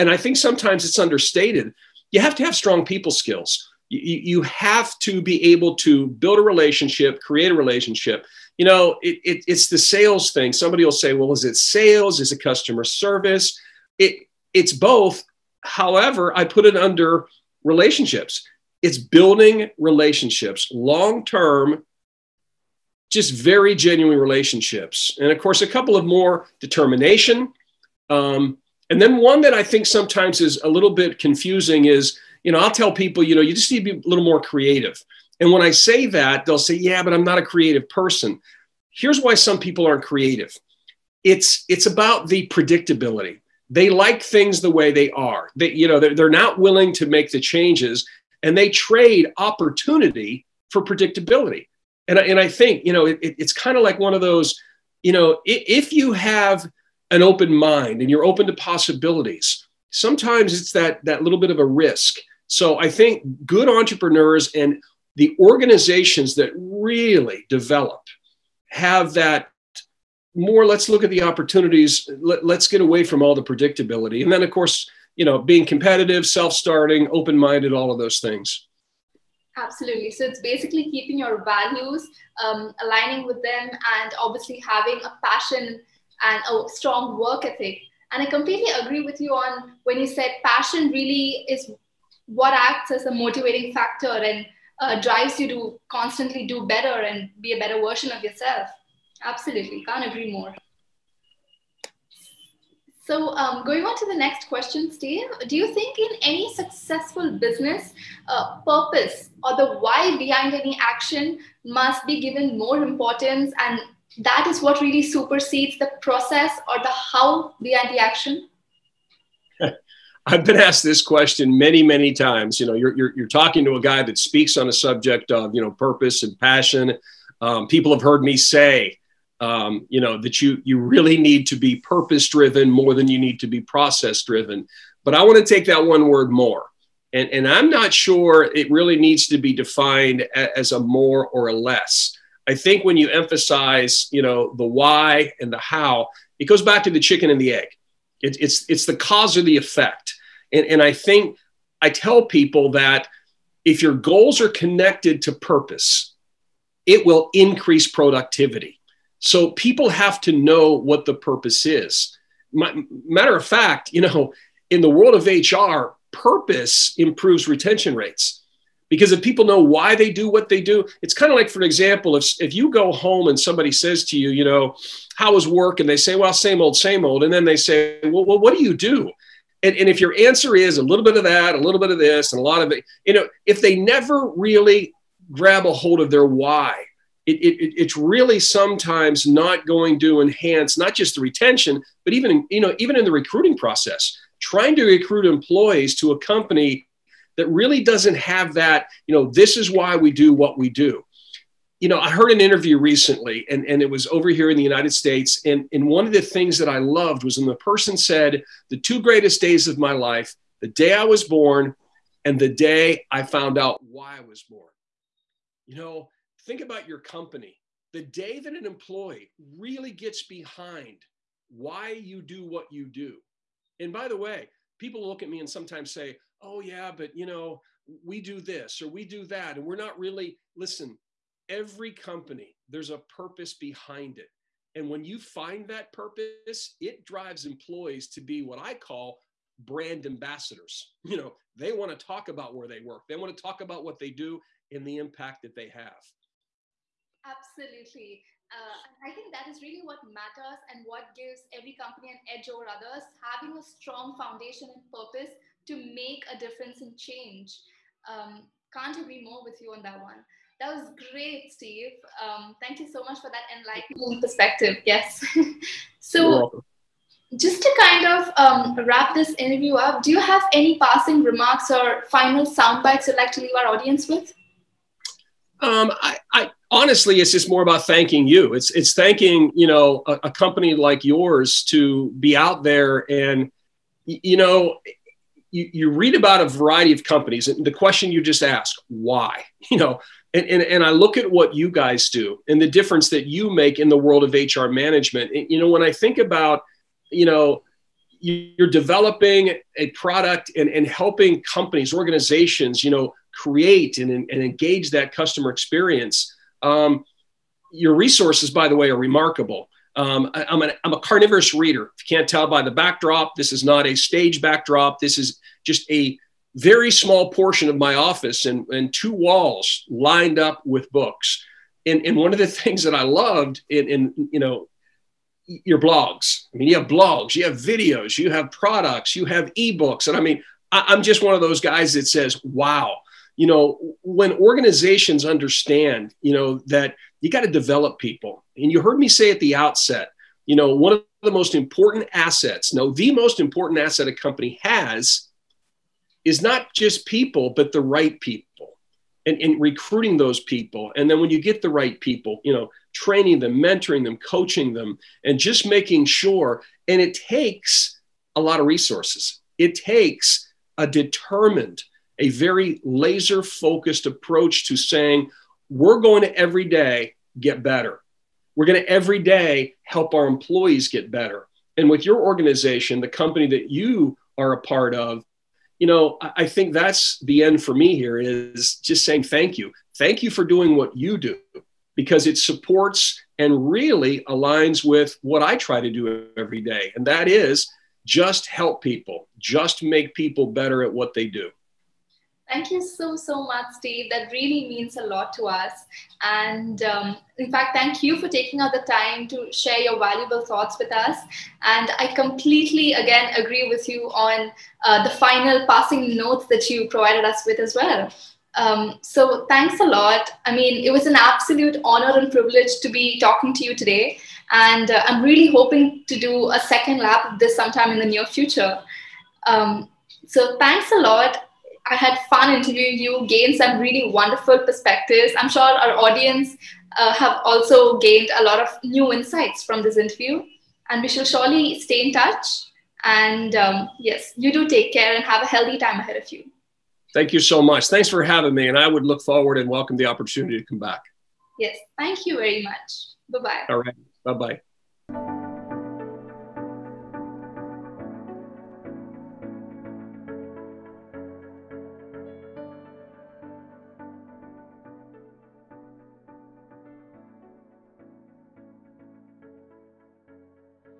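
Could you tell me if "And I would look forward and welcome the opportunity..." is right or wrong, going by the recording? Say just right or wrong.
right.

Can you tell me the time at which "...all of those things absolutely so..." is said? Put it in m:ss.
1:17.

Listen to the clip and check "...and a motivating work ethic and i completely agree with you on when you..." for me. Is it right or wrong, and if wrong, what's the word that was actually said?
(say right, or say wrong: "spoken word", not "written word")
wrong: "strong", not "motivating".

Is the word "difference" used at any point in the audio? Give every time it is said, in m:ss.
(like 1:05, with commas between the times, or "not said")
4:16, 4:52.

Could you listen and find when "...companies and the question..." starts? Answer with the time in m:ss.
4:47.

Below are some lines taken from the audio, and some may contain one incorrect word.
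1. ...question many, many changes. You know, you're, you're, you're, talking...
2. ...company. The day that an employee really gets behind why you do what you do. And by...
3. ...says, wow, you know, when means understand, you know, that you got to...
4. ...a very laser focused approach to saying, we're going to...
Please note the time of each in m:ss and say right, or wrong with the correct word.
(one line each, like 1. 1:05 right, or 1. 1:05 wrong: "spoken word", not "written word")
1. 2:01 wrong: "times", not "changes"
2. 3:37 right
3. 5:32 wrong: "organizations", not "means"
4. 6:02 right.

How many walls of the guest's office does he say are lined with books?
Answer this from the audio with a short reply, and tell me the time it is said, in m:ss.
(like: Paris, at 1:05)
2, at 5:18.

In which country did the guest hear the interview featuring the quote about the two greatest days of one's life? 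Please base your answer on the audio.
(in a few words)
United States.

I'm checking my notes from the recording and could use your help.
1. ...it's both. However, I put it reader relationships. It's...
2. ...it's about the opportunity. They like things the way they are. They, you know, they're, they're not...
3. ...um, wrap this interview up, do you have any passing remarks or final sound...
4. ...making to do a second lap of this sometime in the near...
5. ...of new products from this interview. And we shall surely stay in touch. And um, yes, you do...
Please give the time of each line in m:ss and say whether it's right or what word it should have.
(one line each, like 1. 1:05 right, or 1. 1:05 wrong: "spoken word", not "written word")
1. 0:14 wrong: "under", not "reader"
2. 0:41 wrong: "predictability", not "opportunity"
3. 4:28 right
4. 6:55 wrong: "hoping", not "making"
5. 7:08 wrong: "insights", not "products".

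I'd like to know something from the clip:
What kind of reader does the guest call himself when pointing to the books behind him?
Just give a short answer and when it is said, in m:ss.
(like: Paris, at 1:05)
Carnivorous reader, at 5:11.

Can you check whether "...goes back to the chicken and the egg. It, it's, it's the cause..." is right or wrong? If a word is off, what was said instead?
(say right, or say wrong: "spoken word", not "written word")
right.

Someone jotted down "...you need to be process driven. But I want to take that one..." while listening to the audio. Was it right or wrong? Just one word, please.
right.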